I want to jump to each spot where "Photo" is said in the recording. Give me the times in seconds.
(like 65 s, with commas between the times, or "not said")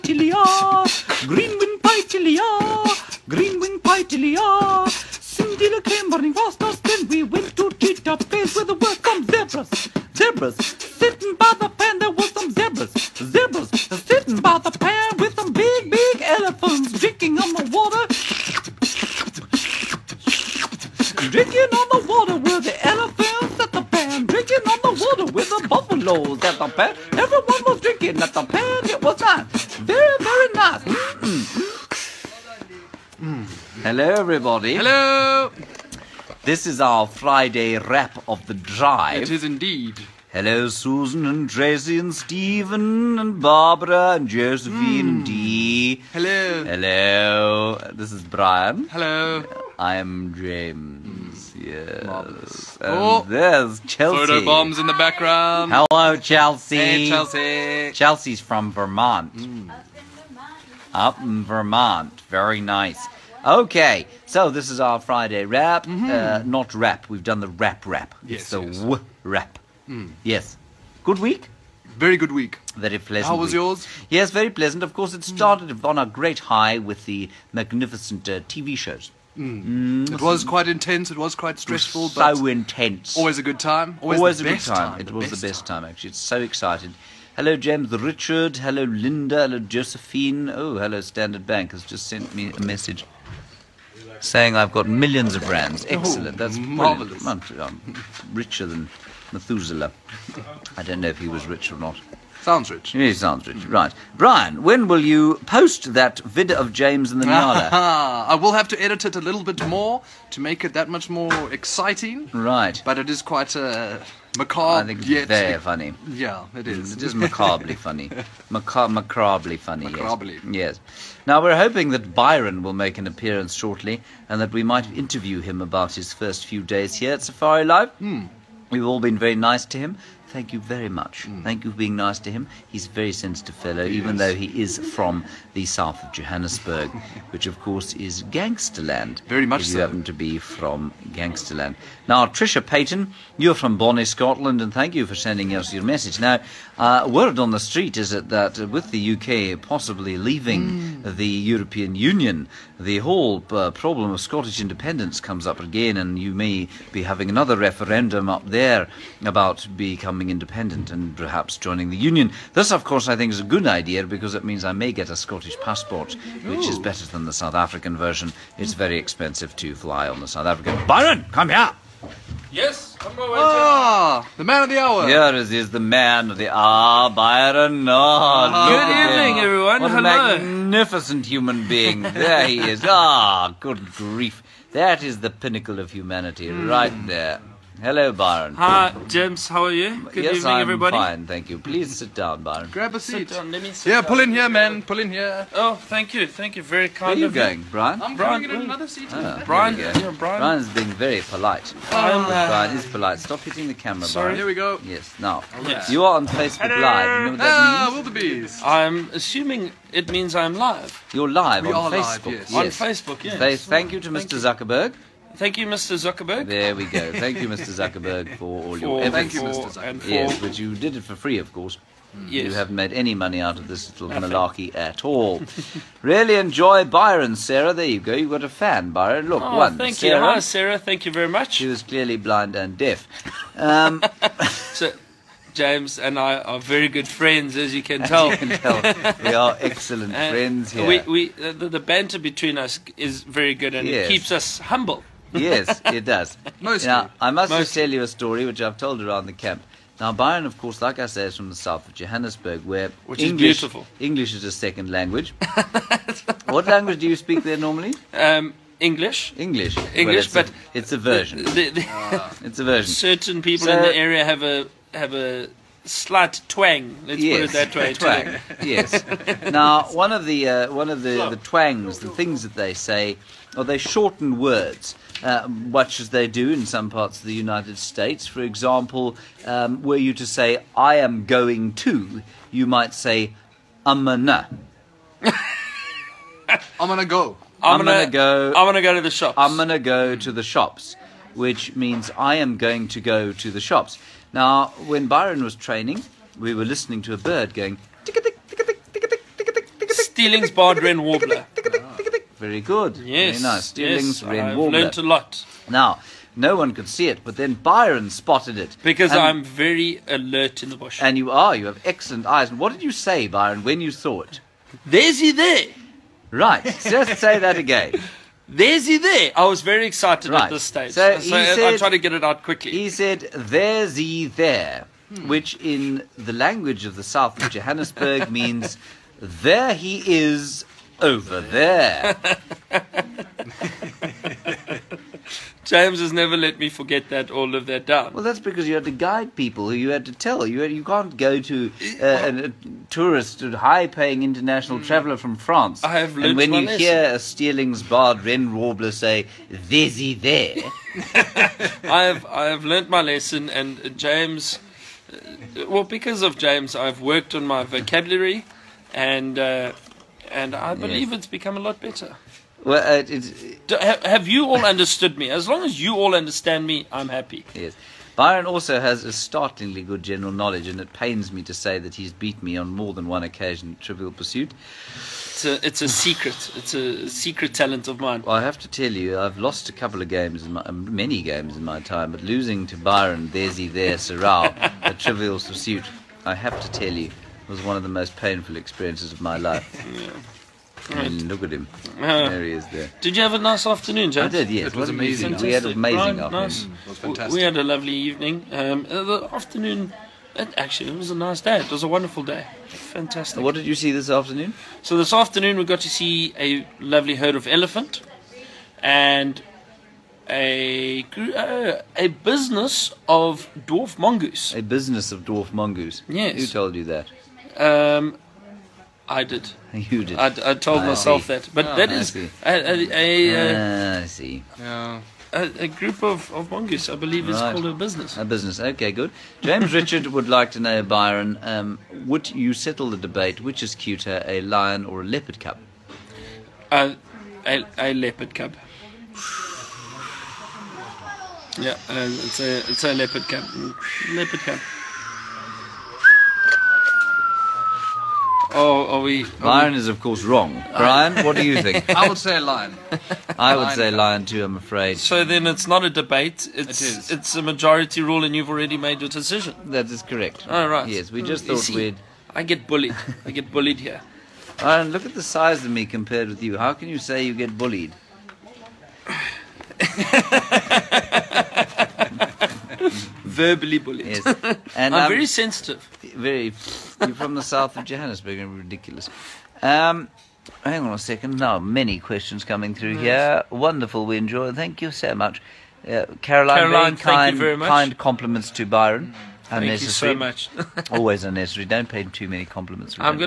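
54 s.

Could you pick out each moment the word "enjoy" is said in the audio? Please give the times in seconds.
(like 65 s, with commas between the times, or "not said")
226 s, 484 s.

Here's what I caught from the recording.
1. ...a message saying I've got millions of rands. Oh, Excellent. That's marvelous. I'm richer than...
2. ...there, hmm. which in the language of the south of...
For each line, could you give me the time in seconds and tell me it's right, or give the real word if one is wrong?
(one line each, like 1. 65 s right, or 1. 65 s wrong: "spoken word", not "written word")
1. 92 s right
2. 324 s right.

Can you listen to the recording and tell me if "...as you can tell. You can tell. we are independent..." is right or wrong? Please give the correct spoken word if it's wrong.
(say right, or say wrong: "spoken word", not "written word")
wrong: "excellent", not "independent".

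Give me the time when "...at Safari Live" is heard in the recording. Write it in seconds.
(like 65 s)
127 s.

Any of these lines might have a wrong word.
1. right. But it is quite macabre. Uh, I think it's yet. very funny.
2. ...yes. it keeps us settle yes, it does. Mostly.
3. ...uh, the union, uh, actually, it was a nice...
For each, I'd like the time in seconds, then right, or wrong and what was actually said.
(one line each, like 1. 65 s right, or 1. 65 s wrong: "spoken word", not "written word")
1. 112 s right
2. 243 s wrong: "humble", not "settle"
3. 398 s wrong: "afternoon", not "union".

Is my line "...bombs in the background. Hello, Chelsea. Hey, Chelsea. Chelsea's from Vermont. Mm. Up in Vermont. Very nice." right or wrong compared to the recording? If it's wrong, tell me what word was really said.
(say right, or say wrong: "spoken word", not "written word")
right.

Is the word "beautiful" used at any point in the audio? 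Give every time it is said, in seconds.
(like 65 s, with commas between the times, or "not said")
253 s.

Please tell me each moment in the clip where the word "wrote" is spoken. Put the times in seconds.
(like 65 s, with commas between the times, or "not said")
not said.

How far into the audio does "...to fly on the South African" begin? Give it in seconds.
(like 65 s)
169 s.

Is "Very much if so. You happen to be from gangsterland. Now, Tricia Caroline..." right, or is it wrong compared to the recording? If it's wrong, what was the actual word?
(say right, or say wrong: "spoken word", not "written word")
wrong: "Payton", not "Caroline".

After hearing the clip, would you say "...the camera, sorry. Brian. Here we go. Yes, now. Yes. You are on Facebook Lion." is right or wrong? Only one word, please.
wrong.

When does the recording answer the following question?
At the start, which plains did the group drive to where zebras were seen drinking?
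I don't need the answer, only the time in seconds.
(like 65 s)
7 s.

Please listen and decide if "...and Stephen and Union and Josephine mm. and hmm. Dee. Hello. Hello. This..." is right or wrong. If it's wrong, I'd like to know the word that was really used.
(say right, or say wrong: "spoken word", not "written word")
wrong: "Barbara", not "Union".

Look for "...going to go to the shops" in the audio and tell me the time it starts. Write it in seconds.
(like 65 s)
292 s.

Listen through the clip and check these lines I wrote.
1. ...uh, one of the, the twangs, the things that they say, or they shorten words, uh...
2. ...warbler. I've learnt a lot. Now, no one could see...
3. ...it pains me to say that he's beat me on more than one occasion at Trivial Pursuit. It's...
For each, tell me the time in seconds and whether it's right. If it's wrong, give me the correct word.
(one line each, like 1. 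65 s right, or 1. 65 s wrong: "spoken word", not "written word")
1. 270 s right
2. 304 s right
3. 370 s right.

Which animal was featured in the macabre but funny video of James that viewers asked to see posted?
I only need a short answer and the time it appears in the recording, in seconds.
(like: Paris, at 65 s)
Nyala, at 107 s.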